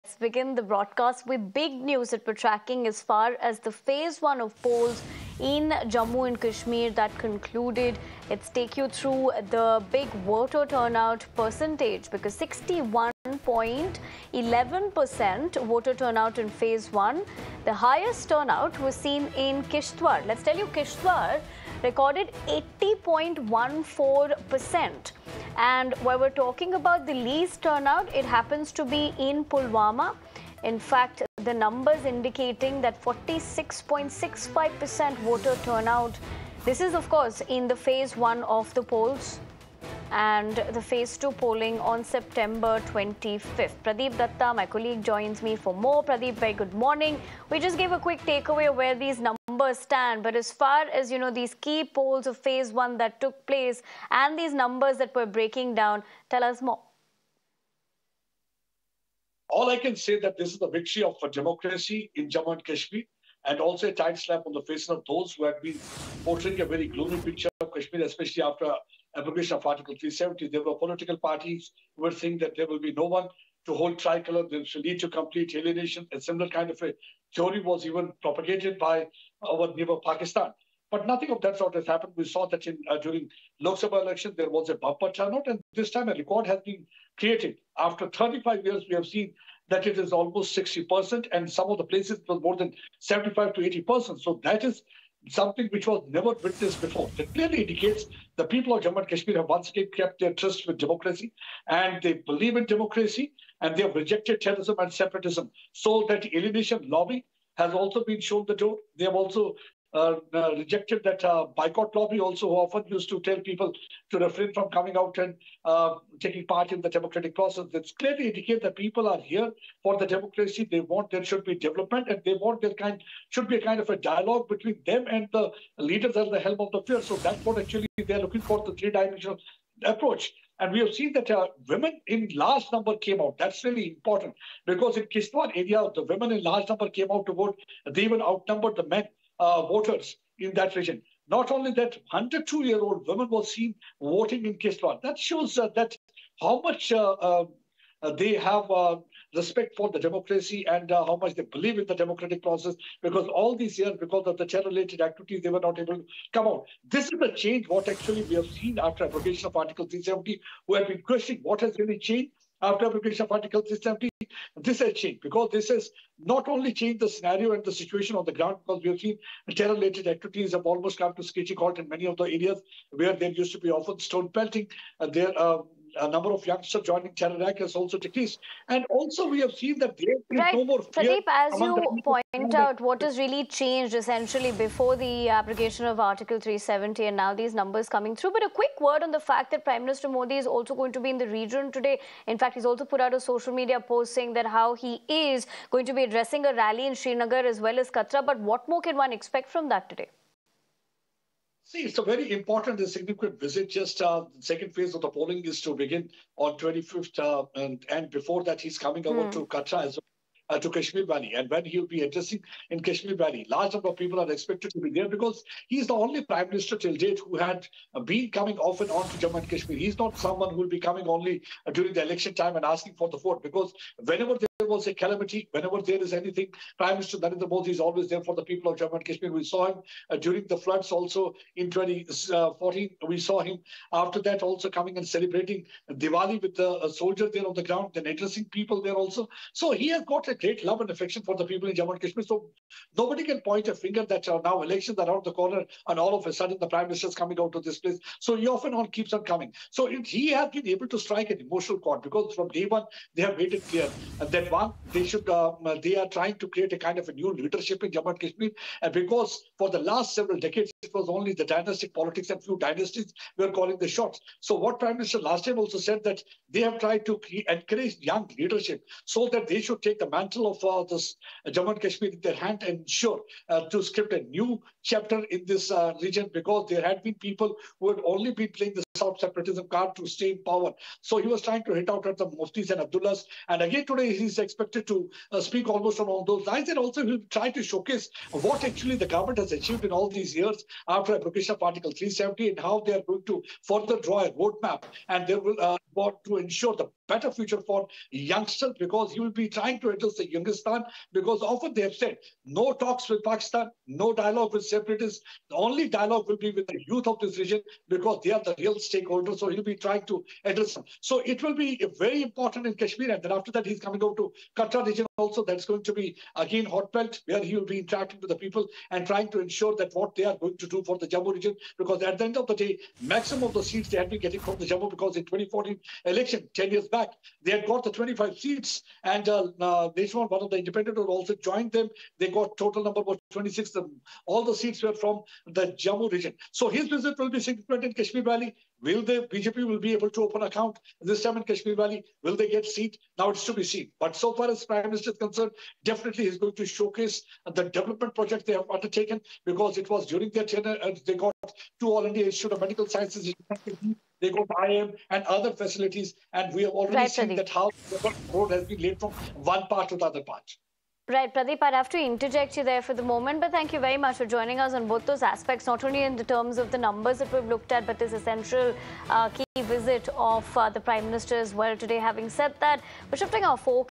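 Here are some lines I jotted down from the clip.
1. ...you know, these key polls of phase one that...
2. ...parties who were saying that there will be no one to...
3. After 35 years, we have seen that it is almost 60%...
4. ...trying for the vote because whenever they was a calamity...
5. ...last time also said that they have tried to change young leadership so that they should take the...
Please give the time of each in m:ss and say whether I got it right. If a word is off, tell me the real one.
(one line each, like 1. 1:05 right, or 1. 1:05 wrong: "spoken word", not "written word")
1. 0:51 right
2. 1:11 right
3. 1:27 right
4. 3:42 wrong: "asking", not "trying"
5. 4:25 wrong: "encourage", not "change".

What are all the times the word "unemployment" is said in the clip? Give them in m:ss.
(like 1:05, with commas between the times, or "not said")
not said.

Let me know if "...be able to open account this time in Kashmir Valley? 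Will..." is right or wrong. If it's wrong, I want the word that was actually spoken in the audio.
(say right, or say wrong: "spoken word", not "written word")
right.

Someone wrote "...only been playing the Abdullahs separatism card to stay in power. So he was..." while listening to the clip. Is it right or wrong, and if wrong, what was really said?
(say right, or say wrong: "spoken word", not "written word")
wrong: "South", not "Abdullahs".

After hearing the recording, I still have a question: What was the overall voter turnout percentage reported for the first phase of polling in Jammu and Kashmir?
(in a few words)
61.11%.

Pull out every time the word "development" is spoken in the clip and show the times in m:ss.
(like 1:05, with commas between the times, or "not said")
2:01, 5:47.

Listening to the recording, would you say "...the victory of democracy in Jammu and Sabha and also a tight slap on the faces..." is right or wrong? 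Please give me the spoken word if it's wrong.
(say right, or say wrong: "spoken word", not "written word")
wrong: "Kashmir", not "Sabha".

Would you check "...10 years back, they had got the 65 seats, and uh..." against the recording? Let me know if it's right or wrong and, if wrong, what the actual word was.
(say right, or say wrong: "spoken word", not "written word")
wrong: "25", not "65".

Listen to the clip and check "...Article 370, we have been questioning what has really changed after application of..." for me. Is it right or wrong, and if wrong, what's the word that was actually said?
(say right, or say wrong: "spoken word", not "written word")
right.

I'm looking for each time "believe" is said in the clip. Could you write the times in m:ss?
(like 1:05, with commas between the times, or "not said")
1:42, 2:31.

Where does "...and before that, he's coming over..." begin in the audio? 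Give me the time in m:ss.
3:27.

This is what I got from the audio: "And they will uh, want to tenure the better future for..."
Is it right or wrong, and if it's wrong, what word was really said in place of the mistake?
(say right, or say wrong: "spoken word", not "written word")
wrong: "ensure", not "tenure".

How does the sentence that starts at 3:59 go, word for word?
So he has got a great love and affection for the people in Jammu and Kashmir.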